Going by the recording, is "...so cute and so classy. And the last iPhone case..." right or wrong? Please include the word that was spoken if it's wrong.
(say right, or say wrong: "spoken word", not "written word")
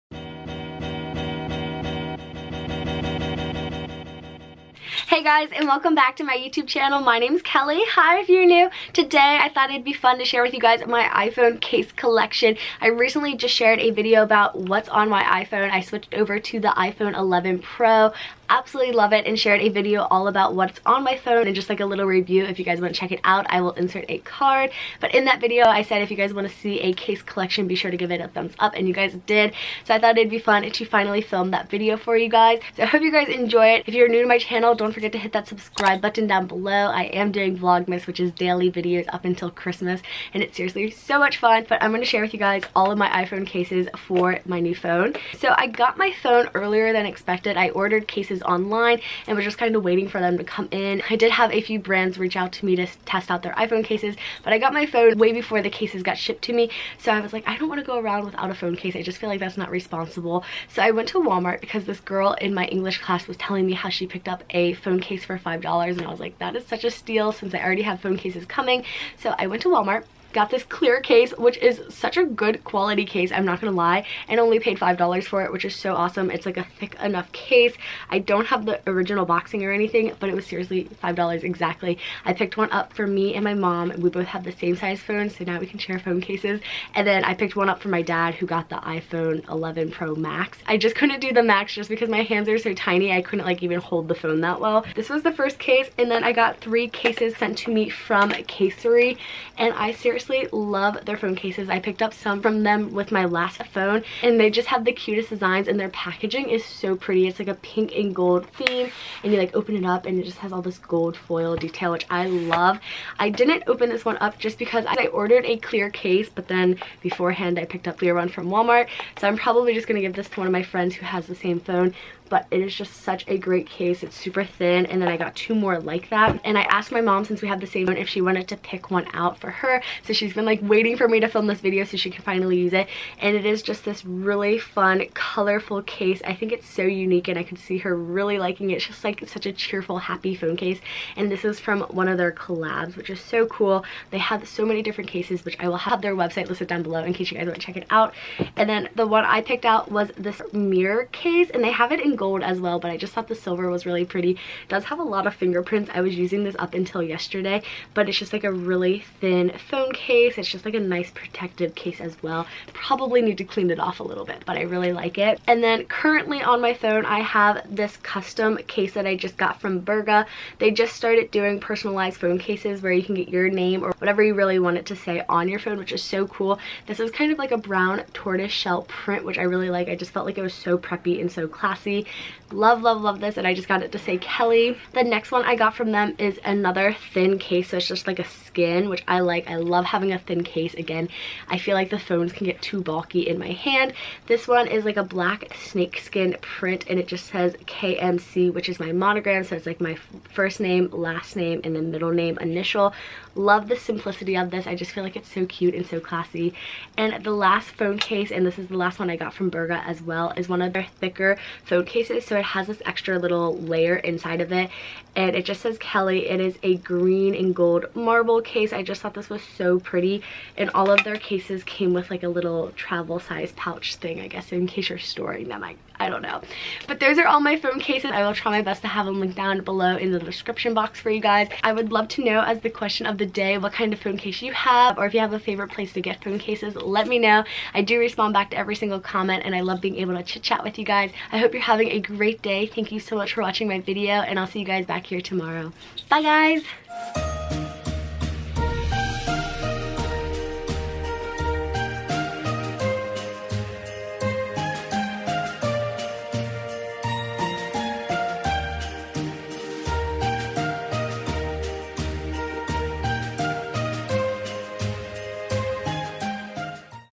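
wrong: "phone", not "iPhone".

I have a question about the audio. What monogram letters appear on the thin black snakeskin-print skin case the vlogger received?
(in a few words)
KMC.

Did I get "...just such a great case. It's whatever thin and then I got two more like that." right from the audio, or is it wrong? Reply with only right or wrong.
wrong.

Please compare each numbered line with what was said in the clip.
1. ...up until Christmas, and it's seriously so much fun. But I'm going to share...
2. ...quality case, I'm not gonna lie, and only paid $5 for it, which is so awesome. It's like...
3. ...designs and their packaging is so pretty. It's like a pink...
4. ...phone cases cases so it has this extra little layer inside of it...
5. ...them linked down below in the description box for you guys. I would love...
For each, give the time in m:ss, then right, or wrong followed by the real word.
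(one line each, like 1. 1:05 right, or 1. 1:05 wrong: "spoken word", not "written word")
1. 0:39 right
2. 1:12 right
3. 1:45 right
4. 3:31 right
5. 3:49 right.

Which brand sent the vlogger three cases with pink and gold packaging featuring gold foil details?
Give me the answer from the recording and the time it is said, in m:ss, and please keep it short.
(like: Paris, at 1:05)
Casery, at 1:38.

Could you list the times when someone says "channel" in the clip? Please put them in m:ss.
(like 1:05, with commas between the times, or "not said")
0:06, 0:34.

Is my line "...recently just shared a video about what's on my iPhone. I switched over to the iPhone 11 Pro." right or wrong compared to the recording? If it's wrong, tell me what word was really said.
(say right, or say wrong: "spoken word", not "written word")
right.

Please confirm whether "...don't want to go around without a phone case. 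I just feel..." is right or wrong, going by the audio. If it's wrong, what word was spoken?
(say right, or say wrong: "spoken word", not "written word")
right.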